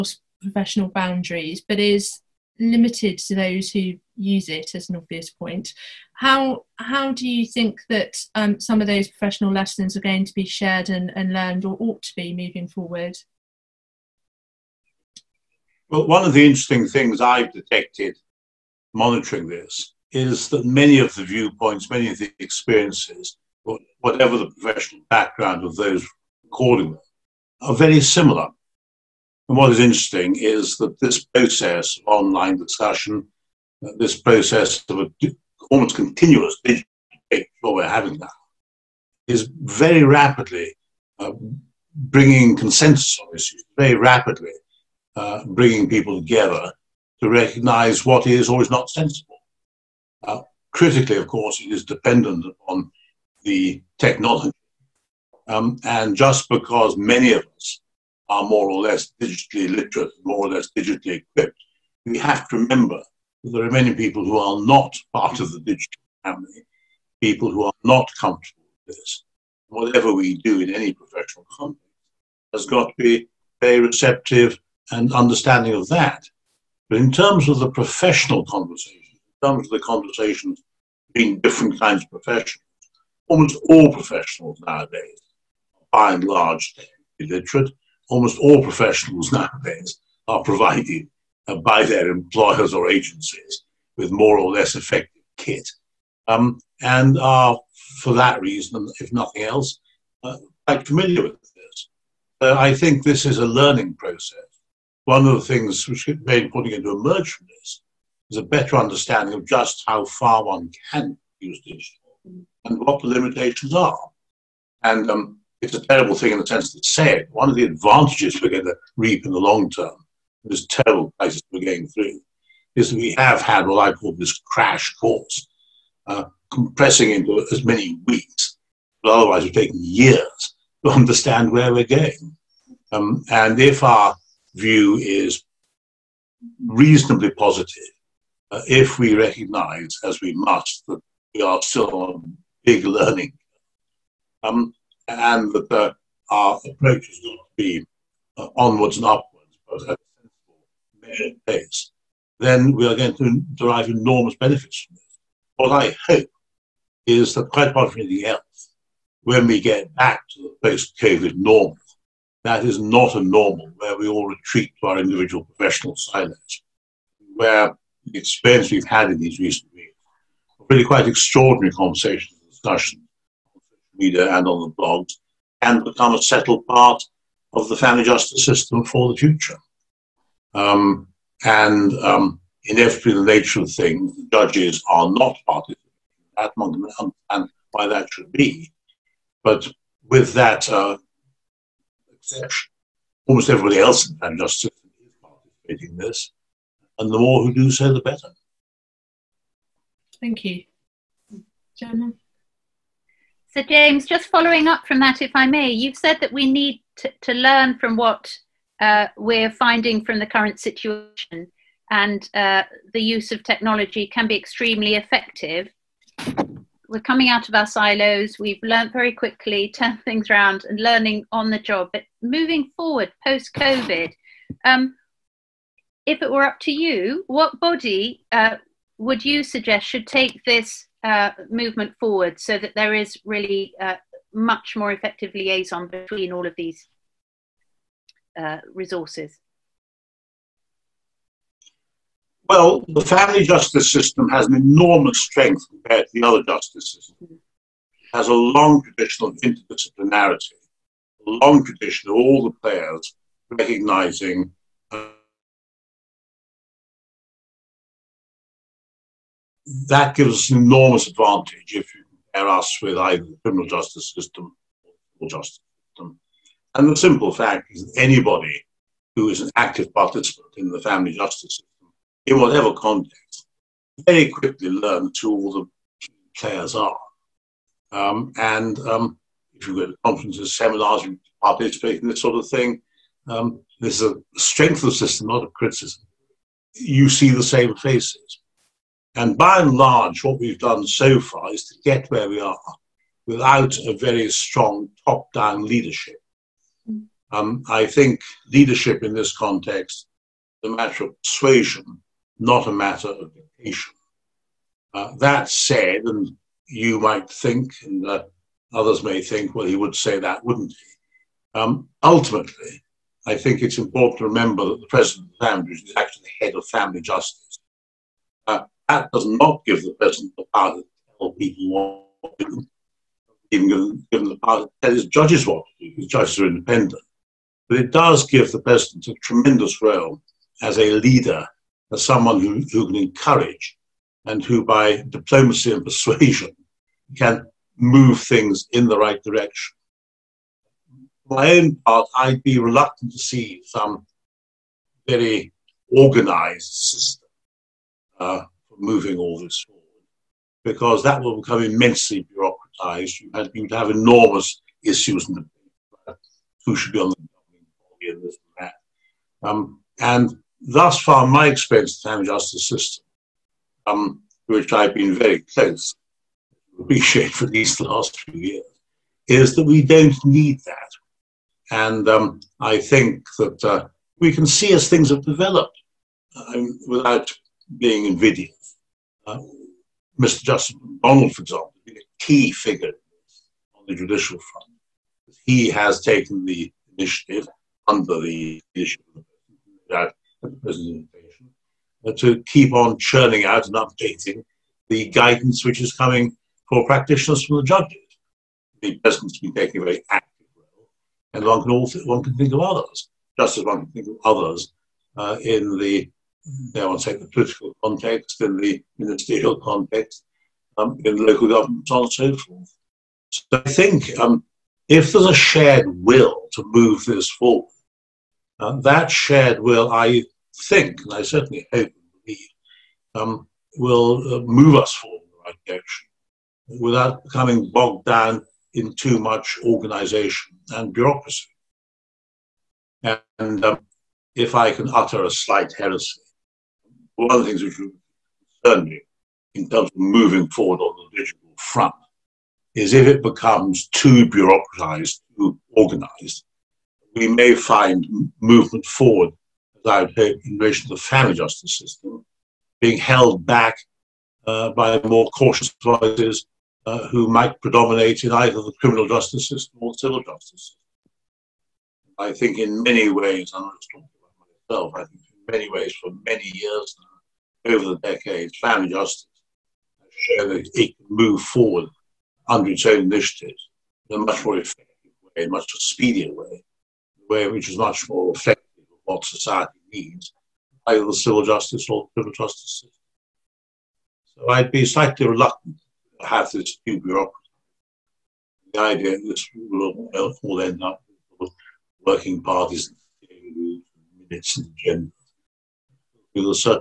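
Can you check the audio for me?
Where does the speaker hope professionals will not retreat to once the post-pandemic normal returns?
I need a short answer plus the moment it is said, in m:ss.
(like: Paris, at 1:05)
individual professional silos, at 2:44.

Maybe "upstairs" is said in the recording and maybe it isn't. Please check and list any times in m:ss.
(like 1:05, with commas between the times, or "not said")
not said.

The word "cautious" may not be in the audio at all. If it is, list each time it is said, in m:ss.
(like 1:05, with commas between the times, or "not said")
7:35.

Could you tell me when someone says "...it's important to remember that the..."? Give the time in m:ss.
5:13.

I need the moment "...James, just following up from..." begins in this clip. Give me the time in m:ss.
3:23.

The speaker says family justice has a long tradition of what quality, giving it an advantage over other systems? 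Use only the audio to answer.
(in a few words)
interdisciplinarity.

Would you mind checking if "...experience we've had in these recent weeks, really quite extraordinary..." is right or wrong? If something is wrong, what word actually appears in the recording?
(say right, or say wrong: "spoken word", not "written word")
right.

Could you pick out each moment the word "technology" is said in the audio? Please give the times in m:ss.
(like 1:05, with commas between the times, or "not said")
0:53, 3:33.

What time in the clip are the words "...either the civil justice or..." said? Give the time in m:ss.
8:00.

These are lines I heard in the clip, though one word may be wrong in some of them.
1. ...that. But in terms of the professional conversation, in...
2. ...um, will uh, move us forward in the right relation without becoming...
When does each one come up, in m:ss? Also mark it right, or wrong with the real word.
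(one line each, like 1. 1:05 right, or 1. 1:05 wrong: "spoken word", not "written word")
1. 1:15 right
2. 7:03 wrong: "direction", not "relation".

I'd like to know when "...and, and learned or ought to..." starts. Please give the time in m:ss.
0:10.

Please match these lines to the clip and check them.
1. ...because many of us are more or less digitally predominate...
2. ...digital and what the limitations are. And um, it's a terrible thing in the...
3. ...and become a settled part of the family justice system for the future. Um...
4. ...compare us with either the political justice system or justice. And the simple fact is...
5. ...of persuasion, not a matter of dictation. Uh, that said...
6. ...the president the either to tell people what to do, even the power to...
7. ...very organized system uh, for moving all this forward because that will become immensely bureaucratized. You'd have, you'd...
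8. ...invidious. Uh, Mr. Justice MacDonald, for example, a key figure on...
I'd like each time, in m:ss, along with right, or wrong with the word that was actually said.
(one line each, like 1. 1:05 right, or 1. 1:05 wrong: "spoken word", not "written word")
1. 0:56 wrong: "literate", not "predominate"
2. 1:51 right
3. 2:55 right
4. 4:22 wrong: "criminal", not "political"
5. 5:01 right
6. 5:19 wrong: "power", not "either"
7. 5:45 right
8. 6:18 right.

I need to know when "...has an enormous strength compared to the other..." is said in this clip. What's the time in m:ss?
4:04.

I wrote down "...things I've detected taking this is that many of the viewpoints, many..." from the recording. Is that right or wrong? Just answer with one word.
wrong.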